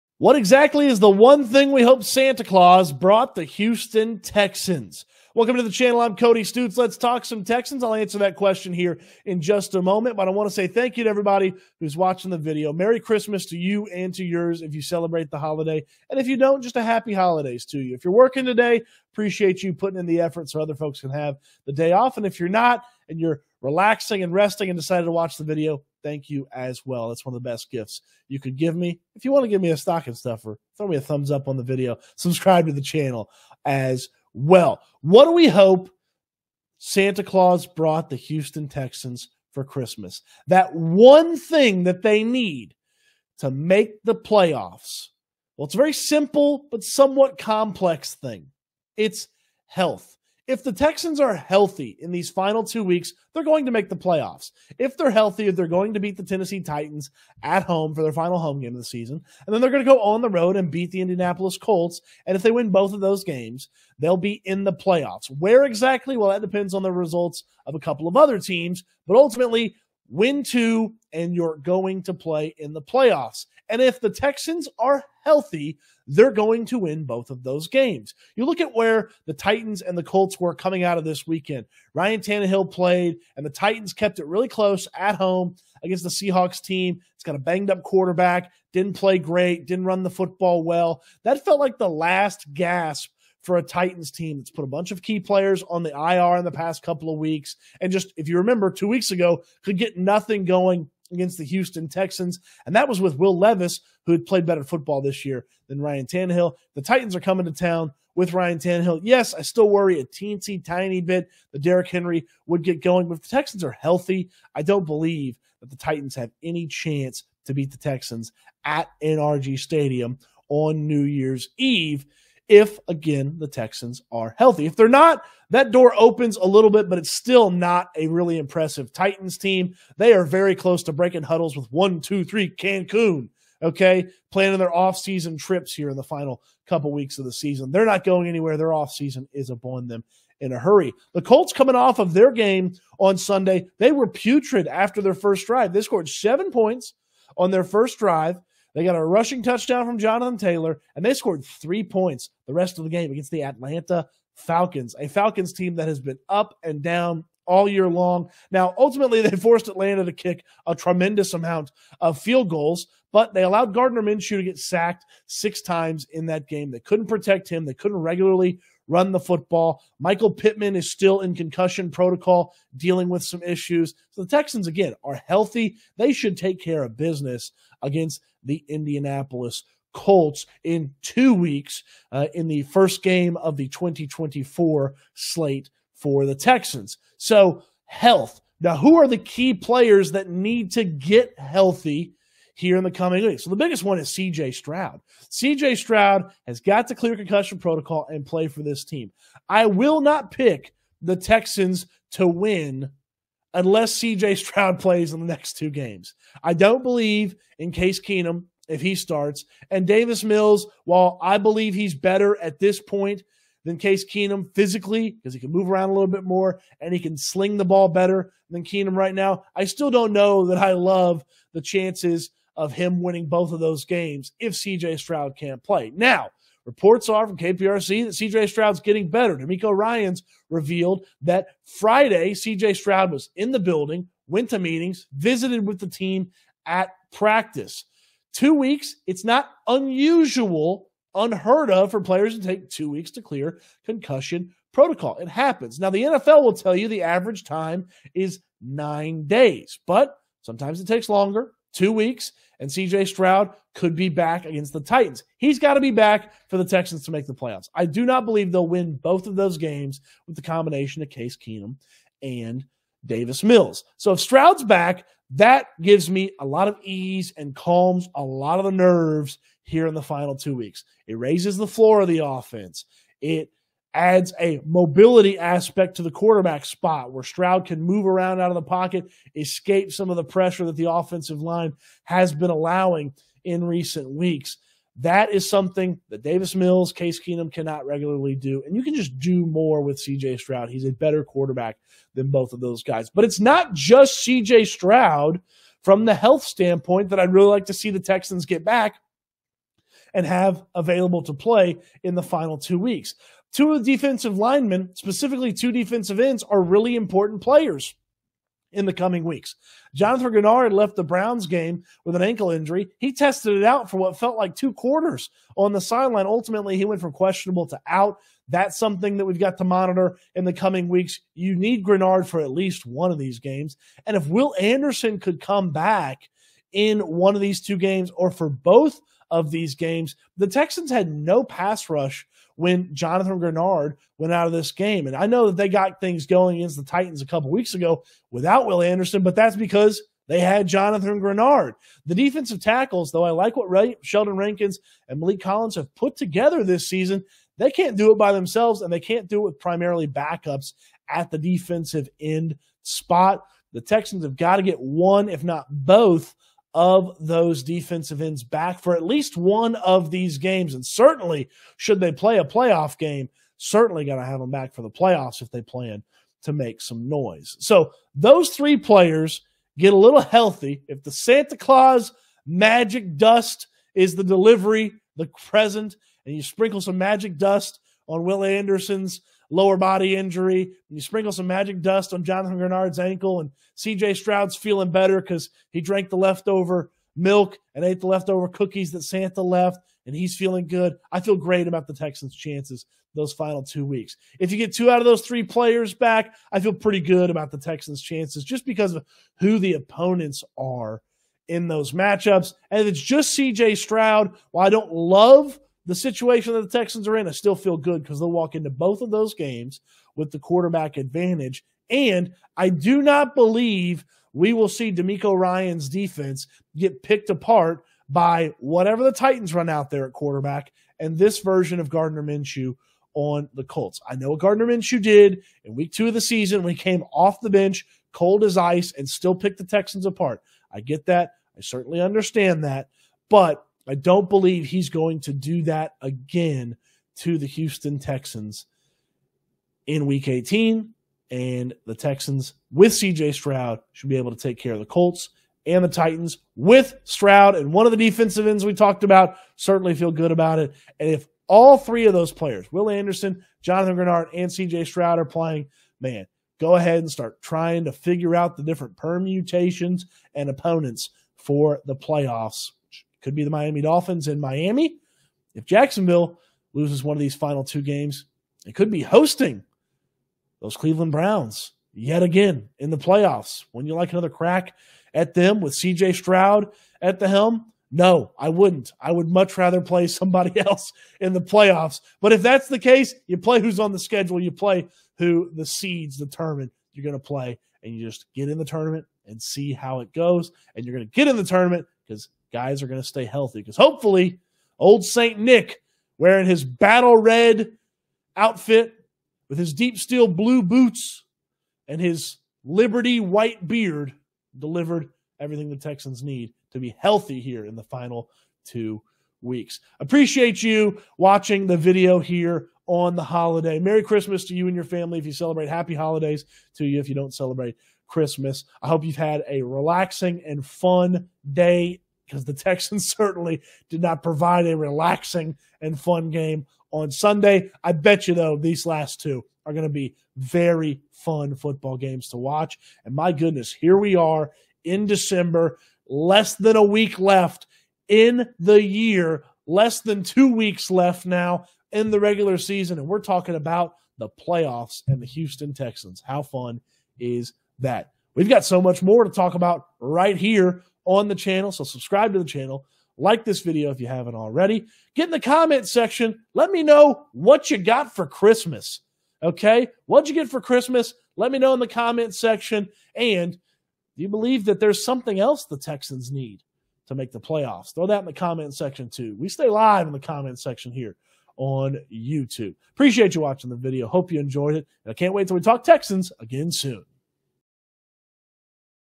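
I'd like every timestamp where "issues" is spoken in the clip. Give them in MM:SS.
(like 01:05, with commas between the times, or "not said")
02:53.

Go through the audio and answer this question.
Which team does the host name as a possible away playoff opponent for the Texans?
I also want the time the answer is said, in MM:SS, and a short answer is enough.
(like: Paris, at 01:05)
Miami Dolphins, at 07:43.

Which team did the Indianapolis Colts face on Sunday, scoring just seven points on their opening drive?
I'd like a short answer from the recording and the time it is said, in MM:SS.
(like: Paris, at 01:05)
Atlanta Falcons, at 02:33.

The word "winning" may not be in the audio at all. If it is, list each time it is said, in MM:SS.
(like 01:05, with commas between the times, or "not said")
03:43.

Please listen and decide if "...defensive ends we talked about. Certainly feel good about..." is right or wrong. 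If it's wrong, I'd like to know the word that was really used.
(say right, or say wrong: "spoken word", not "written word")
right.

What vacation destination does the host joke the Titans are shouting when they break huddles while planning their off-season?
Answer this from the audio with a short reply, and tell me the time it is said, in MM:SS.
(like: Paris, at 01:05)
Cancun, at 02:12.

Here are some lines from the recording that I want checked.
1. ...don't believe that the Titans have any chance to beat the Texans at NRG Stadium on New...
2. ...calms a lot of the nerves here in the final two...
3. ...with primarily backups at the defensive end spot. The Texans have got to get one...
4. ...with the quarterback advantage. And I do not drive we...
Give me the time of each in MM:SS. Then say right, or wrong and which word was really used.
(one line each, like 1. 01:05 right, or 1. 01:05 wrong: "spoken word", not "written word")
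1. 01:54 right
2. 04:27 right
3. 05:49 right
4. 06:50 wrong: "believe", not "drive".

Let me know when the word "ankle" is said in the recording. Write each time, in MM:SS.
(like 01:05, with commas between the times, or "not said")
05:12, 06:22.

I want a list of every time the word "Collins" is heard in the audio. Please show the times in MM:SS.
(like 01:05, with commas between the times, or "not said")
05:45.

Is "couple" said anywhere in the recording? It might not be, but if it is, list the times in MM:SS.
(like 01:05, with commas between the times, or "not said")
01:07, 01:36, 02:16, 05:37.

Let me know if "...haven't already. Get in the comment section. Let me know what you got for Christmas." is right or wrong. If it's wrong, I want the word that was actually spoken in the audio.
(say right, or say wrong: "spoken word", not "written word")
right.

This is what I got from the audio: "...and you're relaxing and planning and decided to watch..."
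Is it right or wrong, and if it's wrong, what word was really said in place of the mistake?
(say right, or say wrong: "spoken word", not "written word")
wrong: "resting", not "planning".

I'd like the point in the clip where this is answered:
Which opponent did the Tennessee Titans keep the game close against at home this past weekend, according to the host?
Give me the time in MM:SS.
01:26.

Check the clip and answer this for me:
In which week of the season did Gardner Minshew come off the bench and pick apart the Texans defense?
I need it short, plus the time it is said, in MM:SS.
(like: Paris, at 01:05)
Week 2, at 07:05.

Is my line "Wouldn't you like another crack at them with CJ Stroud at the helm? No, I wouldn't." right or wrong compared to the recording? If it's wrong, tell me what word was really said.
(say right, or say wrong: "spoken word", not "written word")
right.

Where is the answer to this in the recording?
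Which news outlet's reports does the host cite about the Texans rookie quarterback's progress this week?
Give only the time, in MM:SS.
03:47.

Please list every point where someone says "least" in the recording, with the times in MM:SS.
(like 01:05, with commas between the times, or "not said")
05:22, 05:59.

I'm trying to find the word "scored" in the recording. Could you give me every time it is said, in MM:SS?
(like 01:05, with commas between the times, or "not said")
02:25, 02:31.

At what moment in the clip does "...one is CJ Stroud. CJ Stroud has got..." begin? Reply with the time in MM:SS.
03:13.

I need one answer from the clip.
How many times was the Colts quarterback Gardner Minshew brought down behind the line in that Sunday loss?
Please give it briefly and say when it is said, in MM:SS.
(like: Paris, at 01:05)
6, at 02:45.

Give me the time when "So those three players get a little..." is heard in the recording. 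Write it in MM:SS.
06:07.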